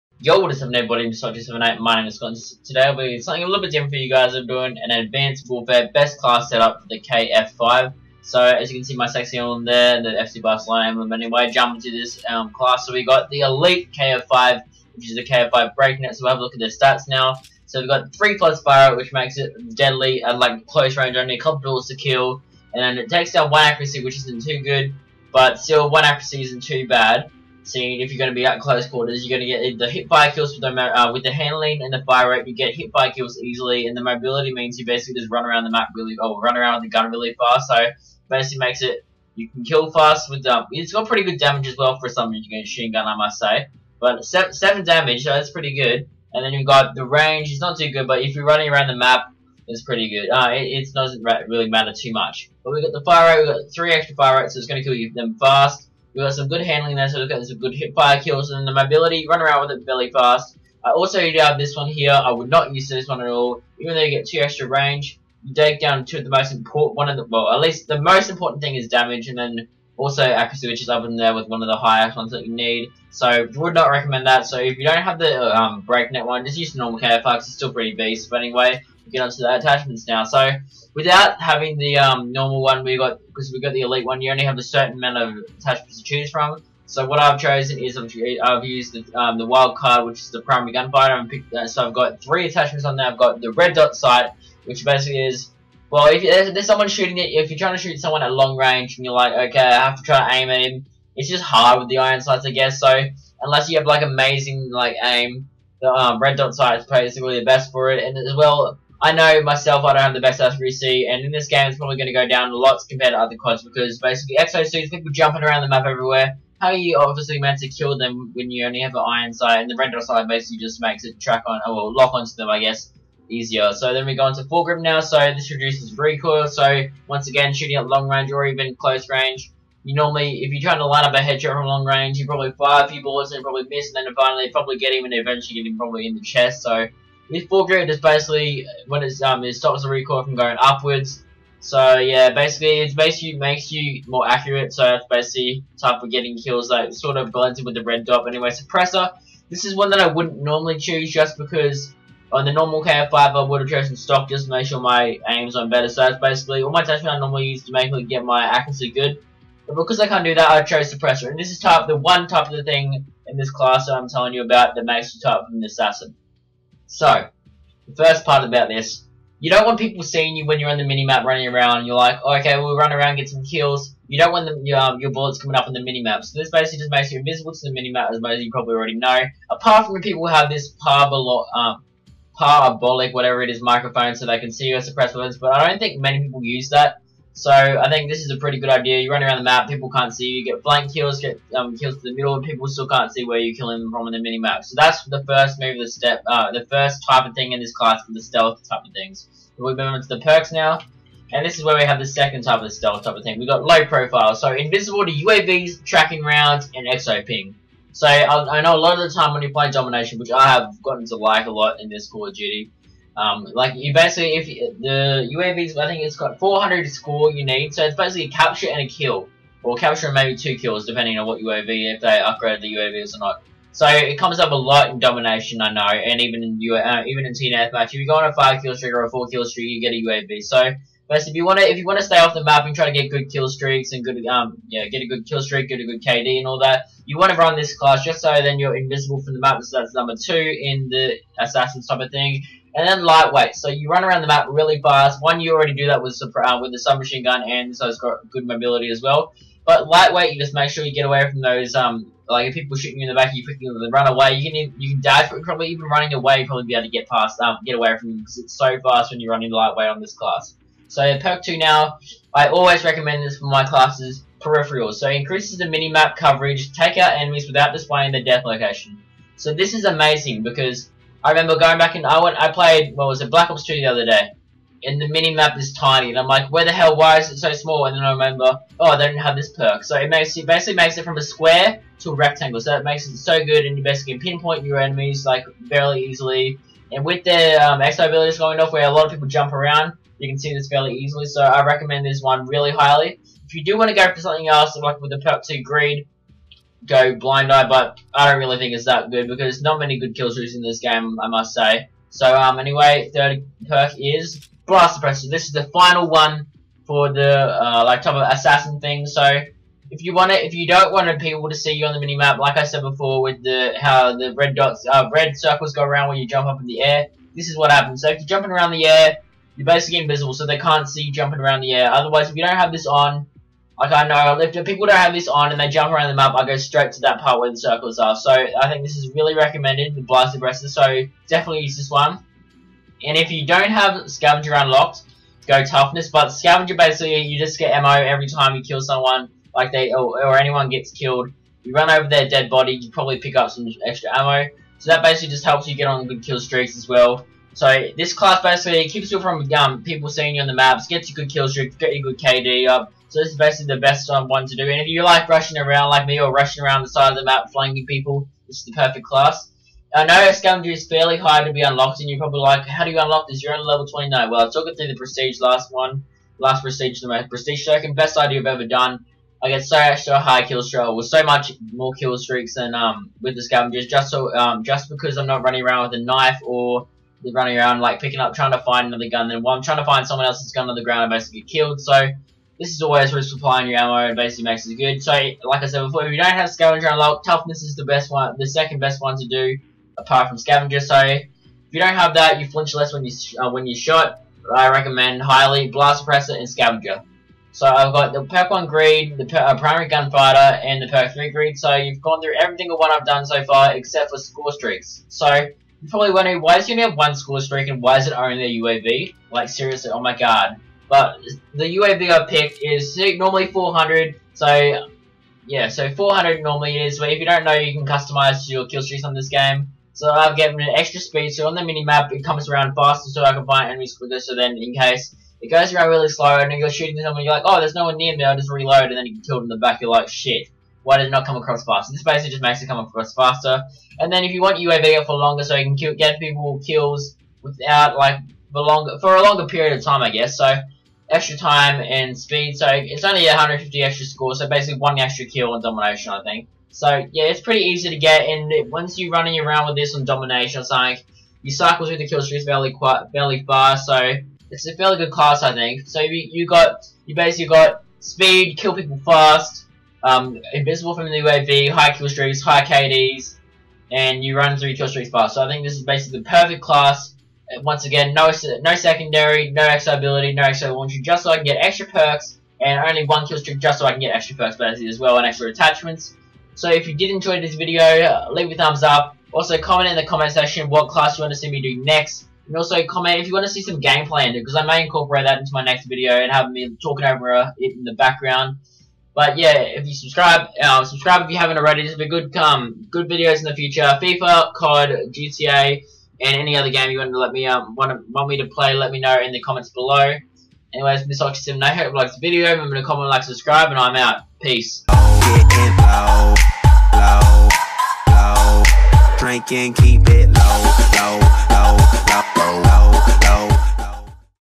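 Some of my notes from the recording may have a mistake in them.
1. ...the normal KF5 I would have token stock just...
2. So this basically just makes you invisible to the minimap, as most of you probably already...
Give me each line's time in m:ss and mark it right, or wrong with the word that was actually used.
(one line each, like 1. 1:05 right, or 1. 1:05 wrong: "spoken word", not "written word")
1. 2:32 wrong: "chosen", not "token"
2. 2:56 right.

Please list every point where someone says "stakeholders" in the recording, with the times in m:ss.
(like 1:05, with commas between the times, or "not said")
not said.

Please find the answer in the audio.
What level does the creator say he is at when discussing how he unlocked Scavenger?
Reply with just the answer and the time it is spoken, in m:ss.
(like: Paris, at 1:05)
29, at 6:03.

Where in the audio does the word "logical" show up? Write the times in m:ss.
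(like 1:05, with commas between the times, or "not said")
not said.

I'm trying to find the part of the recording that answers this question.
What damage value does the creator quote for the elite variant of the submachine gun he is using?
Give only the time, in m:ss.
0:44.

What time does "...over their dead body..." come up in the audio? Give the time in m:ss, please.
5:41.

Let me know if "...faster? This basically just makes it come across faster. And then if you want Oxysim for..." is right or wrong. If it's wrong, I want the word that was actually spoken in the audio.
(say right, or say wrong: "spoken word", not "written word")
wrong: "UAV", not "Oxysim".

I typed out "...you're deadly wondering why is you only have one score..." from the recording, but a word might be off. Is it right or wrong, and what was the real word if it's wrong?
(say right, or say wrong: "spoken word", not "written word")
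wrong: "probably", not "deadly".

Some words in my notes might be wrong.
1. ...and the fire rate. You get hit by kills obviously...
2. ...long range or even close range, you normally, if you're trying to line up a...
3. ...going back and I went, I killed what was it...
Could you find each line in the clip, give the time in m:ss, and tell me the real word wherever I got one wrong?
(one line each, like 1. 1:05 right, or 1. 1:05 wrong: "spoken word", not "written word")
1. 0:31 wrong: "easily", not "obviously"
2. 2:07 right
3. 4:31 wrong: "played", not "killed".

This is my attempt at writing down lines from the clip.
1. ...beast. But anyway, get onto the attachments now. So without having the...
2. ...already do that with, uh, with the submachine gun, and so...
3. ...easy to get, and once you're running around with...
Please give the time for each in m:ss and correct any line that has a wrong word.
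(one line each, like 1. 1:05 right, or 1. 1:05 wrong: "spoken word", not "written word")
1. 1:17 right
2. 4:05 right
3. 7:27 right.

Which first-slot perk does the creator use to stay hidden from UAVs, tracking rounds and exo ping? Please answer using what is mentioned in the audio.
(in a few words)
Low Profile.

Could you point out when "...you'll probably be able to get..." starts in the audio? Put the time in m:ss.
4:16.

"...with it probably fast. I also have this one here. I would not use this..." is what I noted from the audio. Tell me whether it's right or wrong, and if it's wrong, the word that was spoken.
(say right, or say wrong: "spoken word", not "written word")
wrong: "belly", not "probably".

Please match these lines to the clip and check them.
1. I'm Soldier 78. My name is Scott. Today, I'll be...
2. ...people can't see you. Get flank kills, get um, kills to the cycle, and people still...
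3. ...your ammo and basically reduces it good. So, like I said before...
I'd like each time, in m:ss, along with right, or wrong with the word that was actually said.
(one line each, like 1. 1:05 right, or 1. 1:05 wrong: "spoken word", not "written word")
1. 0:01 right
2. 3:09 wrong: "middle", not "cycle"
3. 6:23 wrong: "makes", not "reduces".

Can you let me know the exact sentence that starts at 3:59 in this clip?
So that's number two in the assassin type of thing.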